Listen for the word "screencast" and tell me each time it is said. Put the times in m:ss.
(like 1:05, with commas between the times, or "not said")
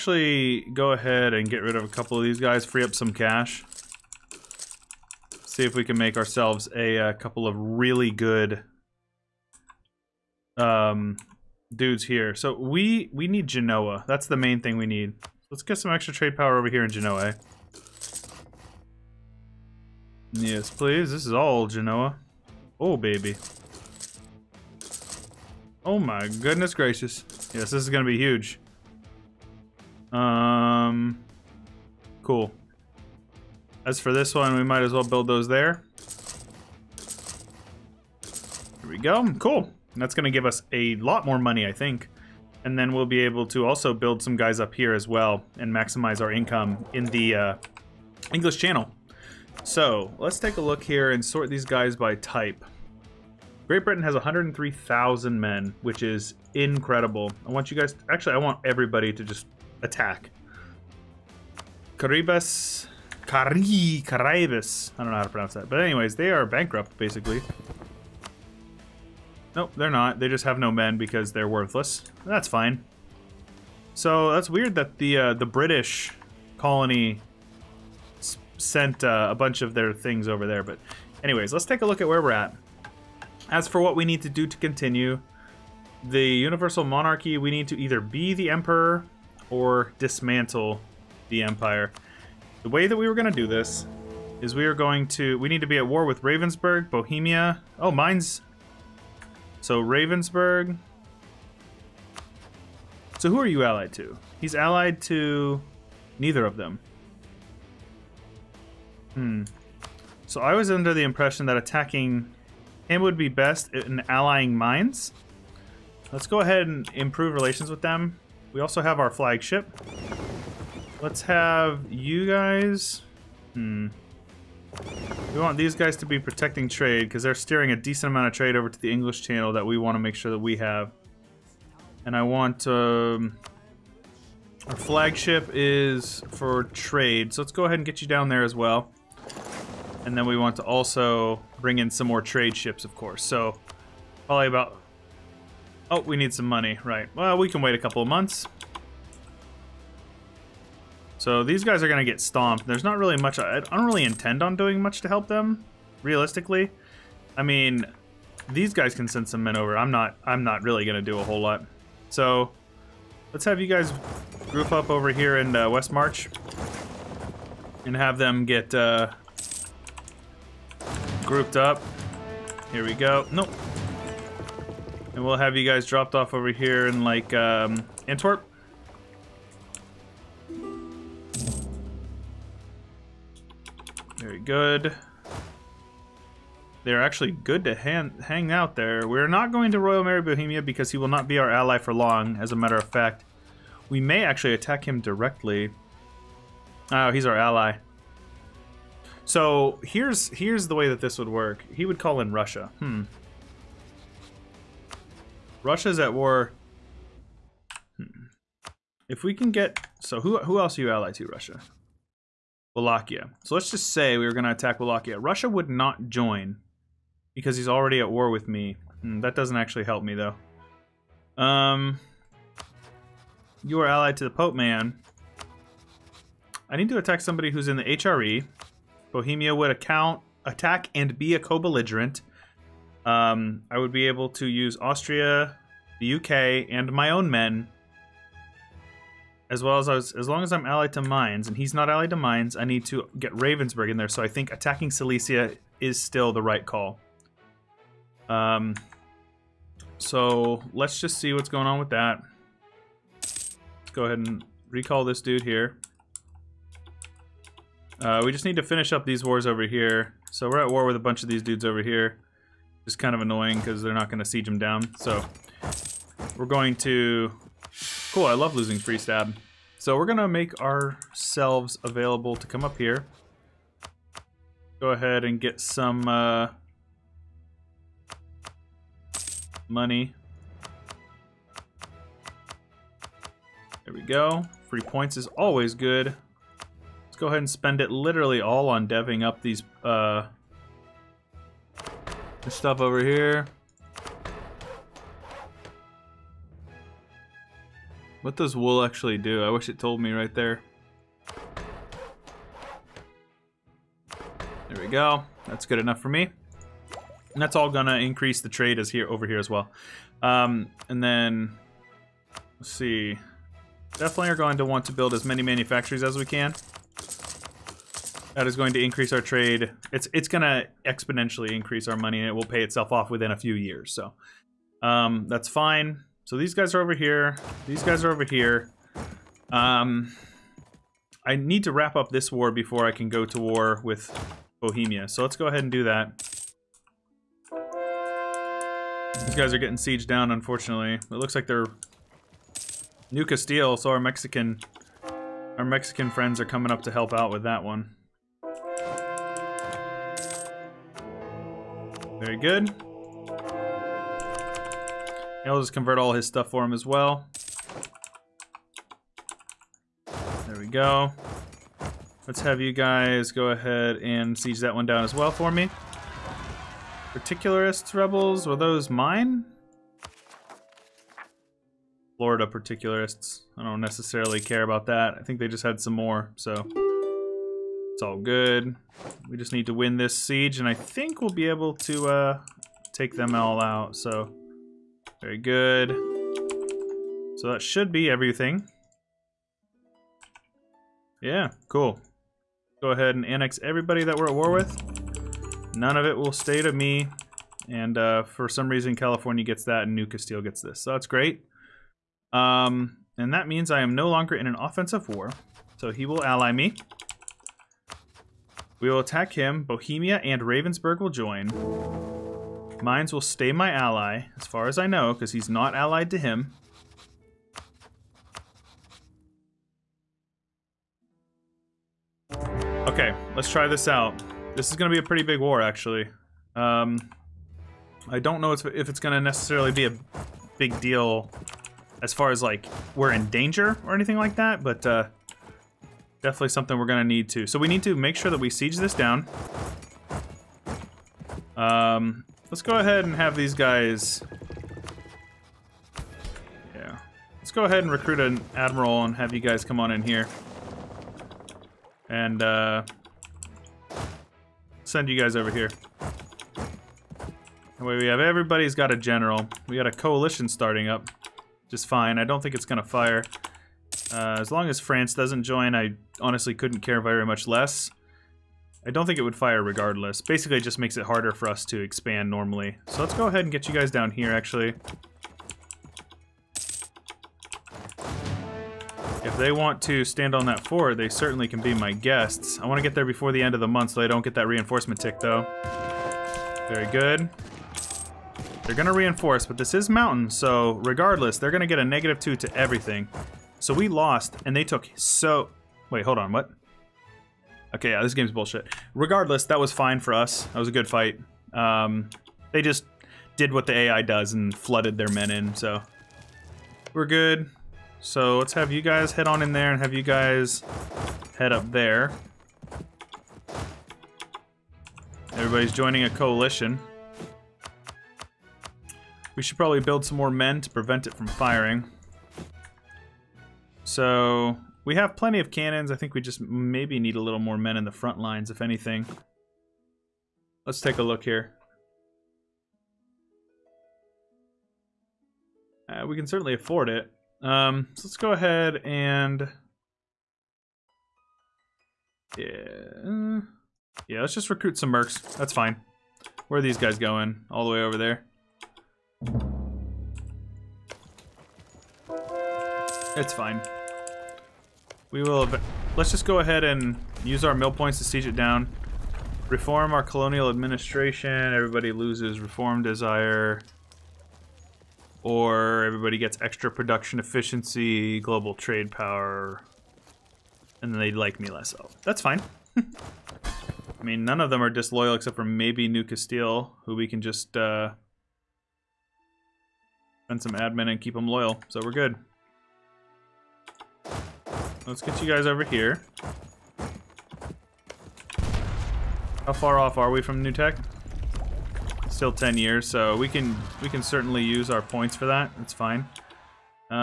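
not said.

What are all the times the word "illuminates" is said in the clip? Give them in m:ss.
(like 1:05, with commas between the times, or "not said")
not said.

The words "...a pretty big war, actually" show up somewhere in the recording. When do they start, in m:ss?
7:04.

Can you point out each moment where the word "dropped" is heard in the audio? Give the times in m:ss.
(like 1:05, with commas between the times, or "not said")
2:55.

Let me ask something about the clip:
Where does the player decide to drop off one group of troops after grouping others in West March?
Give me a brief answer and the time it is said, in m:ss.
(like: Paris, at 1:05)
Antwerp, at 2:58.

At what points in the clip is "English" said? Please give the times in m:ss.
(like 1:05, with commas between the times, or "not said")
0:48, 2:08.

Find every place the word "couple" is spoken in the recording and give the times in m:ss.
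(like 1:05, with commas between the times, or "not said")
0:01, 0:07, 2:27.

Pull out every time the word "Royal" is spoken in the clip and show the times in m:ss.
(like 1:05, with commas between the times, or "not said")
3:09.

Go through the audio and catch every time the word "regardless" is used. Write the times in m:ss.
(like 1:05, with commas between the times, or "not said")
7:49, 8:10, 8:18.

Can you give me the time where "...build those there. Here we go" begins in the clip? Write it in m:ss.
0:35.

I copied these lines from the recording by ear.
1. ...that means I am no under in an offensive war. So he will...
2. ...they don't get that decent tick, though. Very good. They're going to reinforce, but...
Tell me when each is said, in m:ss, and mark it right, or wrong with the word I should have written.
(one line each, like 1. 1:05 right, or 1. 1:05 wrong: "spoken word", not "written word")
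1. 6:43 wrong: "longer", not "under"
2. 8:04 wrong: "reinforcement", not "decent".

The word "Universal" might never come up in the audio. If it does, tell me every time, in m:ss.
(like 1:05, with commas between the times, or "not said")
1:26.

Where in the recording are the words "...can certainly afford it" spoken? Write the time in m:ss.
8:56.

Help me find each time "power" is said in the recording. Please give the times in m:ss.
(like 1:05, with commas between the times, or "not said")
0:16, 9:28.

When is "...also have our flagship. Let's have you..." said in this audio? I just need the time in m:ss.
1:58.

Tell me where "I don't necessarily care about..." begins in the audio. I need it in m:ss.
6:13.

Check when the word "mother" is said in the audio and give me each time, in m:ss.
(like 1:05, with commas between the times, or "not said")
not said.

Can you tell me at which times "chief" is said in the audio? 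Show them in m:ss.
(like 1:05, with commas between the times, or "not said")
not said.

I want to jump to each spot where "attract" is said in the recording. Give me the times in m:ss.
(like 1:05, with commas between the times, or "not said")
not said.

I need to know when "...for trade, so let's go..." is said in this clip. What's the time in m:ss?
2:16.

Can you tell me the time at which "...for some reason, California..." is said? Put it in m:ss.
6:38.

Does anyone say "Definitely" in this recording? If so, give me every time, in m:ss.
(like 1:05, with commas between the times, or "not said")
5:13, 7:16.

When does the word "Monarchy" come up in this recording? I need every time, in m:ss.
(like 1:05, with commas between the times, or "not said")
1:26.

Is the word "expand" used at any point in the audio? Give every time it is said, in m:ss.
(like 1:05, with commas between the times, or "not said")
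7:51.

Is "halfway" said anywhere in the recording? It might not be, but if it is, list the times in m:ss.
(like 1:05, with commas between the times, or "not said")
not said.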